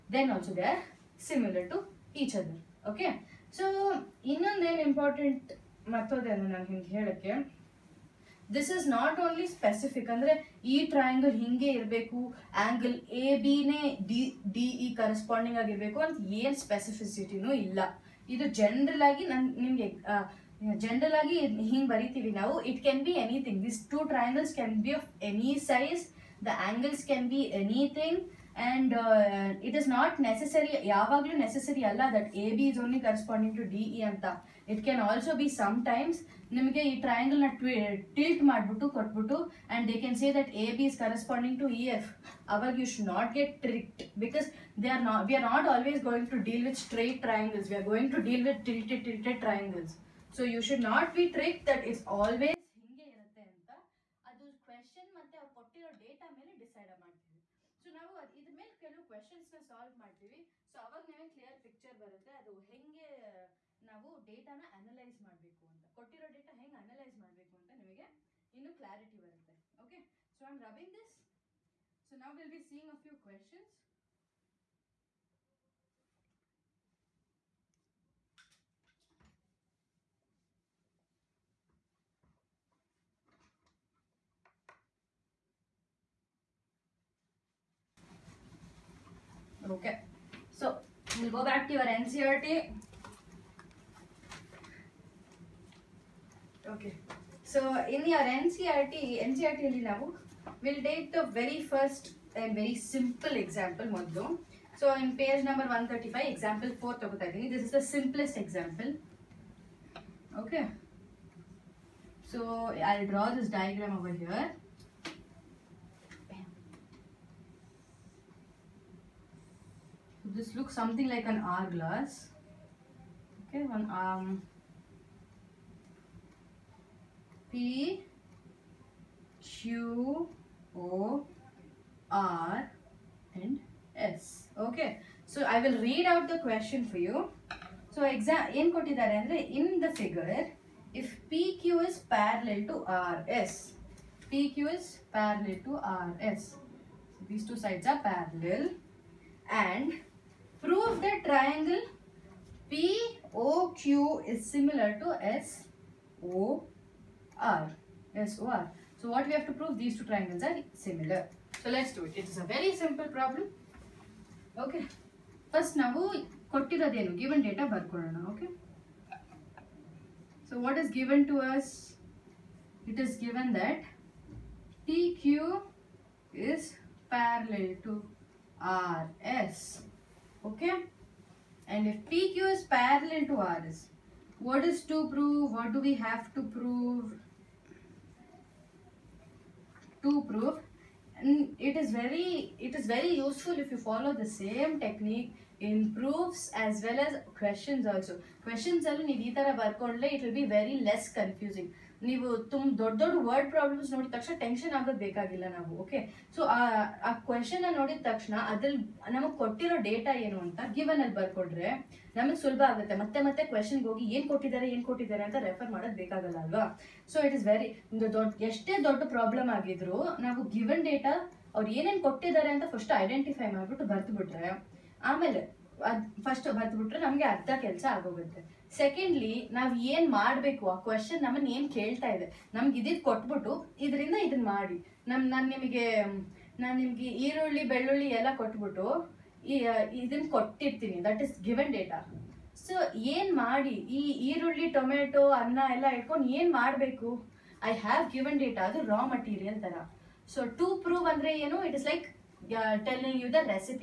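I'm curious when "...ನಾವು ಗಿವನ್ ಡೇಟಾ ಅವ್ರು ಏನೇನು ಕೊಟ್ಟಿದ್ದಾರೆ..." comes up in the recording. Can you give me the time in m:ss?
3:40.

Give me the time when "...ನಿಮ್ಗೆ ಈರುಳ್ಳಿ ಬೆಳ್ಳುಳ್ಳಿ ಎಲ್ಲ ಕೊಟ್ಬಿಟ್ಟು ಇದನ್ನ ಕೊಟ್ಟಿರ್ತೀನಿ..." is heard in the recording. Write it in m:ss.
3:56.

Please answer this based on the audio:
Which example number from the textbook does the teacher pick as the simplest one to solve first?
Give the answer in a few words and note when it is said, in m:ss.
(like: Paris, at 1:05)
4, at 1:46.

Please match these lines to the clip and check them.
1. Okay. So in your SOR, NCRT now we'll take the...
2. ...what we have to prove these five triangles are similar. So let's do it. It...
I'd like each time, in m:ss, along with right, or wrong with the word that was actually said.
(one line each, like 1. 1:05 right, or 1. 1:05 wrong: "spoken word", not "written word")
1. 1:36 wrong: "NCRT", not "SOR"
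2. 2:39 wrong: "two", not "five".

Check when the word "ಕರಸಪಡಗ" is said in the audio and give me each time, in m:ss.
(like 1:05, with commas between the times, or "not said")
0:15, 0:33, 0:41.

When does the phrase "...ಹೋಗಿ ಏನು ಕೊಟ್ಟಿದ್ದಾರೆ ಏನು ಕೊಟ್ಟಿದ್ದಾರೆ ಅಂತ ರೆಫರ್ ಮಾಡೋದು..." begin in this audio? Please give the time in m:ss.
3:33.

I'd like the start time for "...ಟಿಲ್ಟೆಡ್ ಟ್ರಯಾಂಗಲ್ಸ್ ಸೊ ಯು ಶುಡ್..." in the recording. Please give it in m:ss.
0:49.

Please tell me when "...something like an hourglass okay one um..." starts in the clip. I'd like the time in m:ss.
2:00.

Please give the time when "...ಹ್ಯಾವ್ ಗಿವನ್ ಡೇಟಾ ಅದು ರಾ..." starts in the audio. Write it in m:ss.
4:07.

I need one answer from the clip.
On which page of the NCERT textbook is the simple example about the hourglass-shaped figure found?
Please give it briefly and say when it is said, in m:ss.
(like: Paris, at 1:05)
135, at 1:45.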